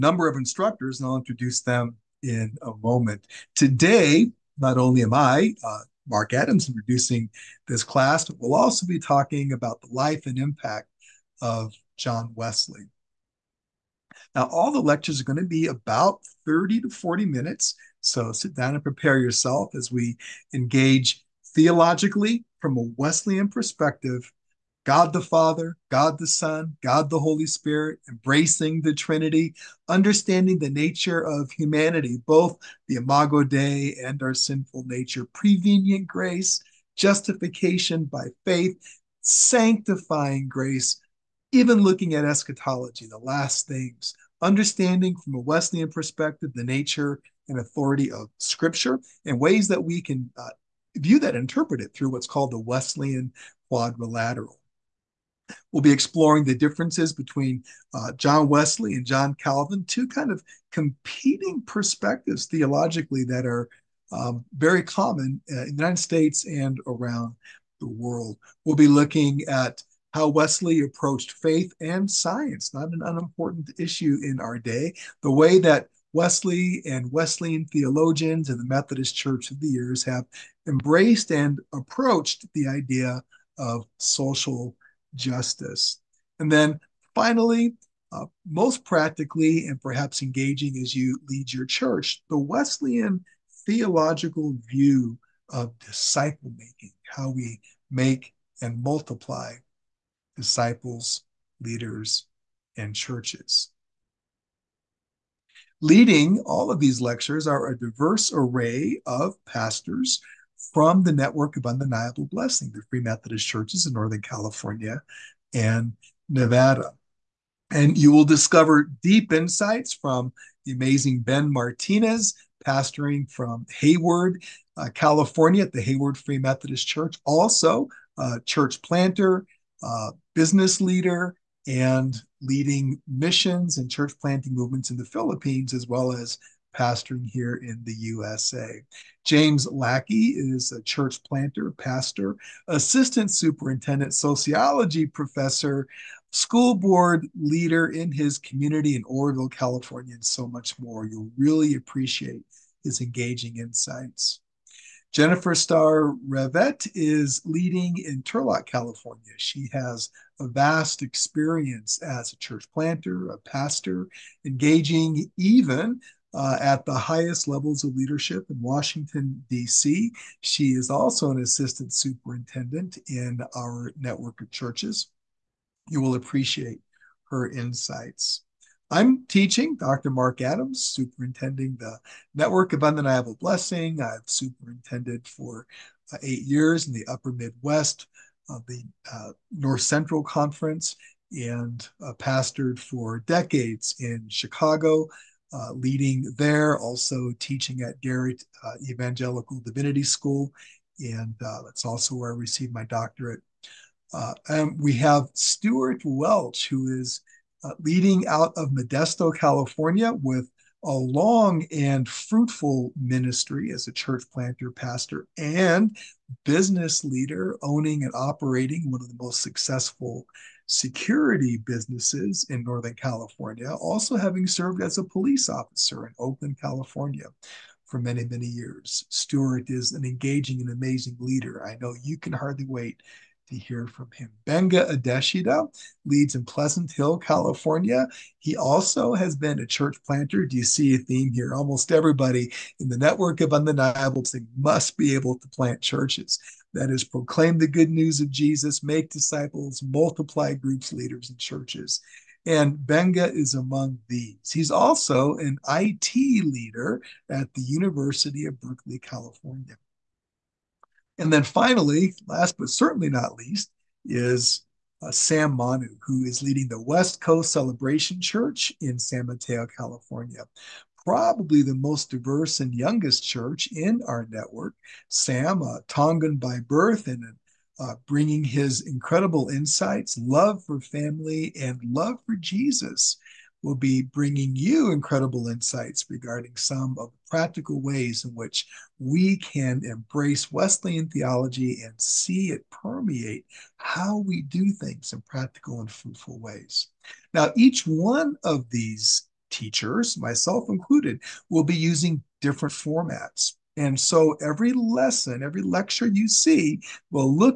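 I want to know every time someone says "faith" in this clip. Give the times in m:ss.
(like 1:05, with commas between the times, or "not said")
0:38, 1:11.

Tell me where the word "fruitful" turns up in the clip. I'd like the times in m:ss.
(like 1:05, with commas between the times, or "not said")
3:32, 4:55.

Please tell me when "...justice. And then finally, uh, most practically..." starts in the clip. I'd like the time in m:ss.
1:25.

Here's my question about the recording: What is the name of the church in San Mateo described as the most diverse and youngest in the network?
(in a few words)
West Coast Celebration Church.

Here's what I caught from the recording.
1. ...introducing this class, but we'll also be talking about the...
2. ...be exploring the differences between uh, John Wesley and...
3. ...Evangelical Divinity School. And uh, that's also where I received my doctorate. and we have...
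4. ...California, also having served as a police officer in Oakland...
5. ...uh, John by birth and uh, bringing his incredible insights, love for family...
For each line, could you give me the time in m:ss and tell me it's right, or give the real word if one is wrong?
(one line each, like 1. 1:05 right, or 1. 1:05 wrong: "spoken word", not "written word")
1. 0:06 right
2. 0:55 right
3. 3:18 right
4. 3:42 right
5. 4:35 wrong: "Tongan", not "John".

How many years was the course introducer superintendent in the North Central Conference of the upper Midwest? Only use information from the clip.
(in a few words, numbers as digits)
8.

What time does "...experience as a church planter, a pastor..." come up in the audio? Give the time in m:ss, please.
2:41.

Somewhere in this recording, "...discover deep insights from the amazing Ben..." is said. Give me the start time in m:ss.
1:58.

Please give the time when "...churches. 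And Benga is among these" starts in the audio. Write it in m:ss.
4:11.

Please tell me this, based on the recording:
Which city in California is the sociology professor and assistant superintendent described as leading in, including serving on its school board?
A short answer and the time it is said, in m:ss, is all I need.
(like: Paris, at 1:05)
Oroville, at 2:29.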